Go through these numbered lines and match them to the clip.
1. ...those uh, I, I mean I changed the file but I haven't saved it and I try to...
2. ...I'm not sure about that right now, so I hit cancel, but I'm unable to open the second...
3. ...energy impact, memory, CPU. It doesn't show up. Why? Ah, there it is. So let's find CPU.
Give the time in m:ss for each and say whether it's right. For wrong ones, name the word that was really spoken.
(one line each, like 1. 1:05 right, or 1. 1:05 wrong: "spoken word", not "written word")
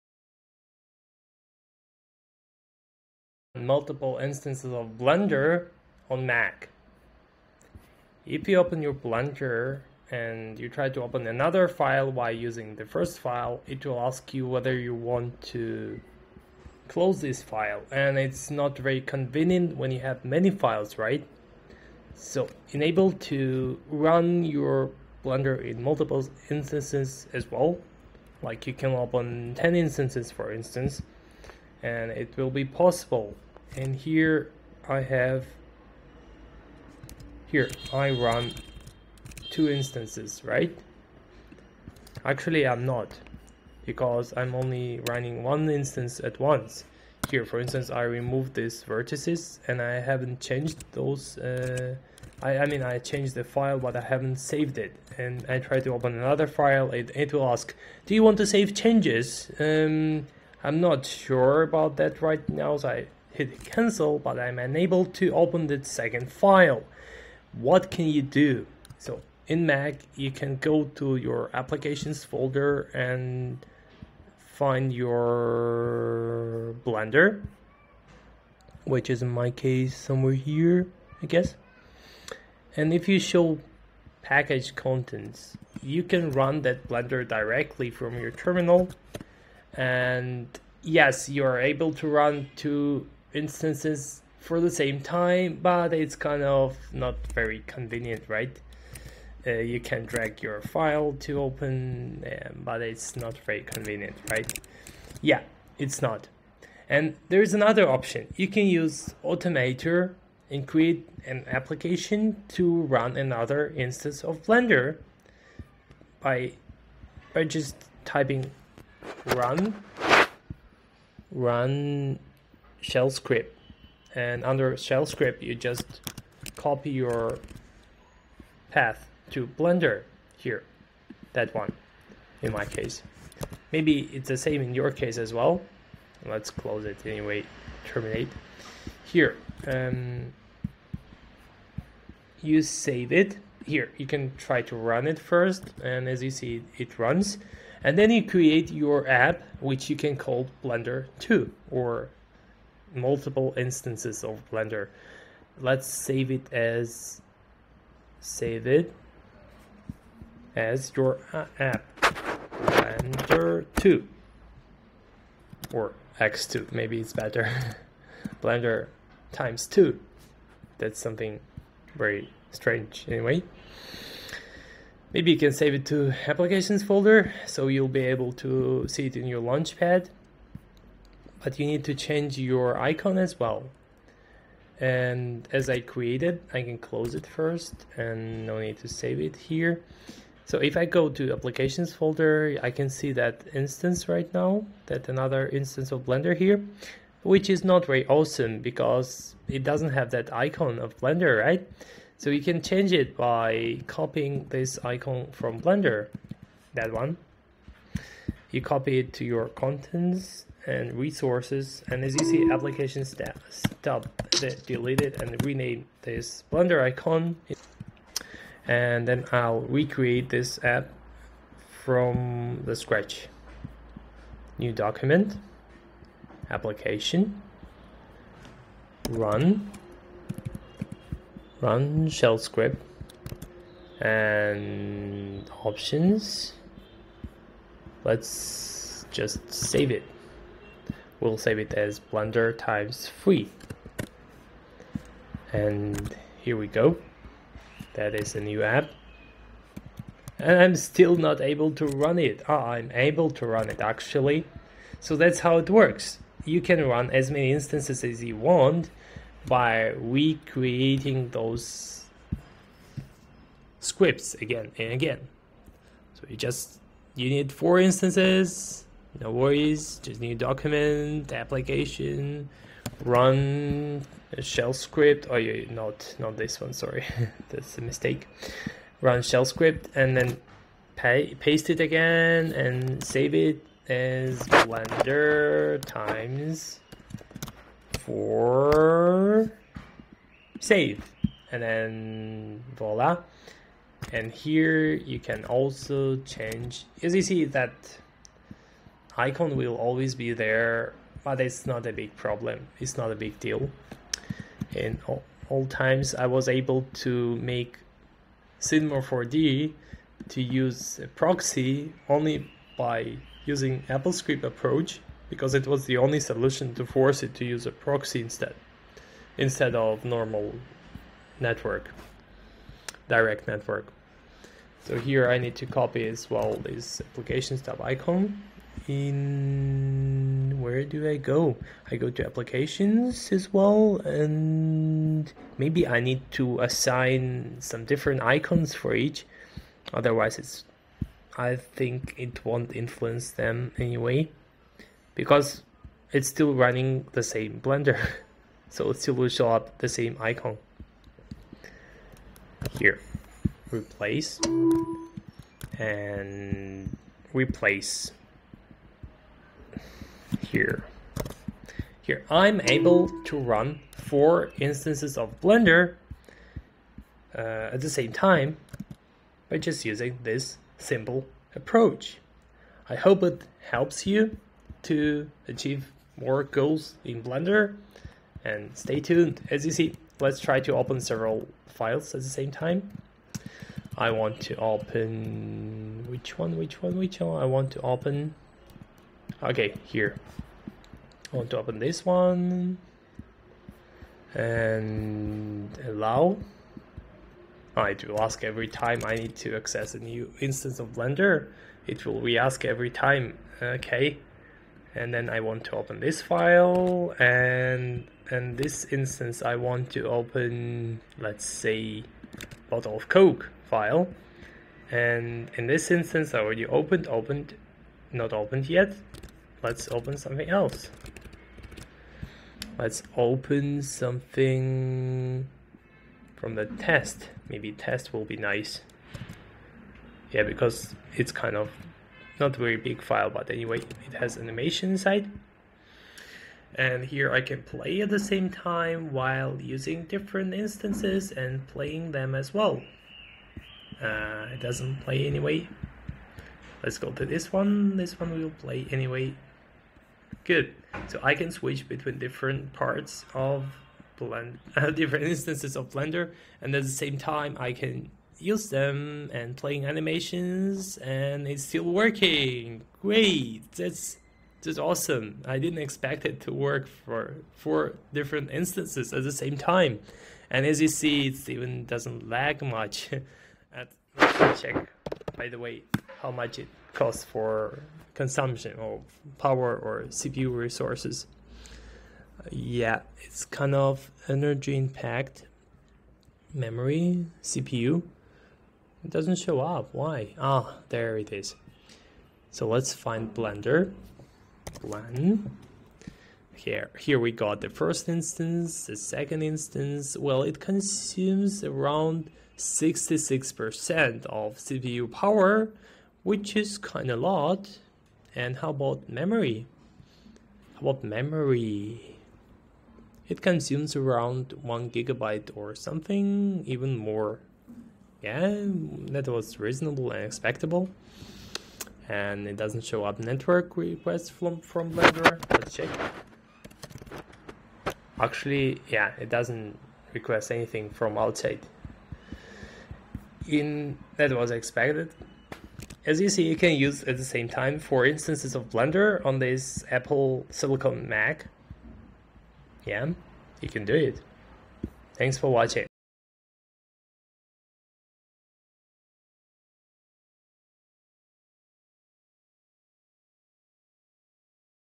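1. 0:50 right
2. 1:00 right
3. 8:04 wrong: "Blender", not "CPU".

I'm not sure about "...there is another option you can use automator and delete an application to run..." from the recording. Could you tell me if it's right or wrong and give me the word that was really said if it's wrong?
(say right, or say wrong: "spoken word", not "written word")
wrong: "create", not "delete".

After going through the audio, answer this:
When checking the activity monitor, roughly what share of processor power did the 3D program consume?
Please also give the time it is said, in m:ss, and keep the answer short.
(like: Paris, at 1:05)
66%, at 8:22.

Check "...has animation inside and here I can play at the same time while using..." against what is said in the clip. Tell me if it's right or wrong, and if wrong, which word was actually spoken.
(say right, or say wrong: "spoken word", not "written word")
right.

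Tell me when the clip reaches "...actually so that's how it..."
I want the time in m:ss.
4:13.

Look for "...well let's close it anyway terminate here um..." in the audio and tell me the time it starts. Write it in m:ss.
2:15.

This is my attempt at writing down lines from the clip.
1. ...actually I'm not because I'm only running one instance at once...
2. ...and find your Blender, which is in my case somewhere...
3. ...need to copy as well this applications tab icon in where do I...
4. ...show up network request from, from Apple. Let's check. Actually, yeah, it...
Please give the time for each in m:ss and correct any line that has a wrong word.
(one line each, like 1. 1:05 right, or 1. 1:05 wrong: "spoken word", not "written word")
1. 0:42 right
2. 1:12 right
3. 5:25 right
4. 8:42 wrong: "Blender", not "Apple".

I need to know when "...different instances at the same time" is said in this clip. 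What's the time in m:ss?
7:48.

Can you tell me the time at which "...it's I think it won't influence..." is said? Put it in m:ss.
5:40.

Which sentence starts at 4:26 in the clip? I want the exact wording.
So you just you need four instances, no worries, just new document, application, run shell script.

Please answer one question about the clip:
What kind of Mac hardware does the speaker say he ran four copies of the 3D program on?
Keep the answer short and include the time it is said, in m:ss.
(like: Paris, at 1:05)
Apple Silicon, at 8:59.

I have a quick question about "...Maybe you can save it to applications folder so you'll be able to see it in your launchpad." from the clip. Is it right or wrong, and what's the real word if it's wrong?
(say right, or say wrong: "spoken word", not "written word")
right.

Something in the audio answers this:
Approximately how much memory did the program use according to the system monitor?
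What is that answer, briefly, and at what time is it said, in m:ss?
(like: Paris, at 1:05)
1 gigabyte, at 8:34.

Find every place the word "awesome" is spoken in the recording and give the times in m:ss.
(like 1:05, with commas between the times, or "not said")
3:18, 7:44.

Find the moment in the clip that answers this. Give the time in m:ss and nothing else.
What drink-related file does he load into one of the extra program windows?
6:52.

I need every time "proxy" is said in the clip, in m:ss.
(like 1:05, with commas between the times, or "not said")
5:11, 5:17.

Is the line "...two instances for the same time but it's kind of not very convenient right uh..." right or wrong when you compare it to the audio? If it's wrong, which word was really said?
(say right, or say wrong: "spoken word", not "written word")
right.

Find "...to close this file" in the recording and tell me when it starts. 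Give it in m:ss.
0:15.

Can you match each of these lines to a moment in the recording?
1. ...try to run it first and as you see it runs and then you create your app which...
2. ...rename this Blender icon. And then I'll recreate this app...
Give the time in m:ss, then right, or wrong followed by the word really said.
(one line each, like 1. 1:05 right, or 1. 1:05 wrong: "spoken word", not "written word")
1. 2:24 right
2. 3:35 right.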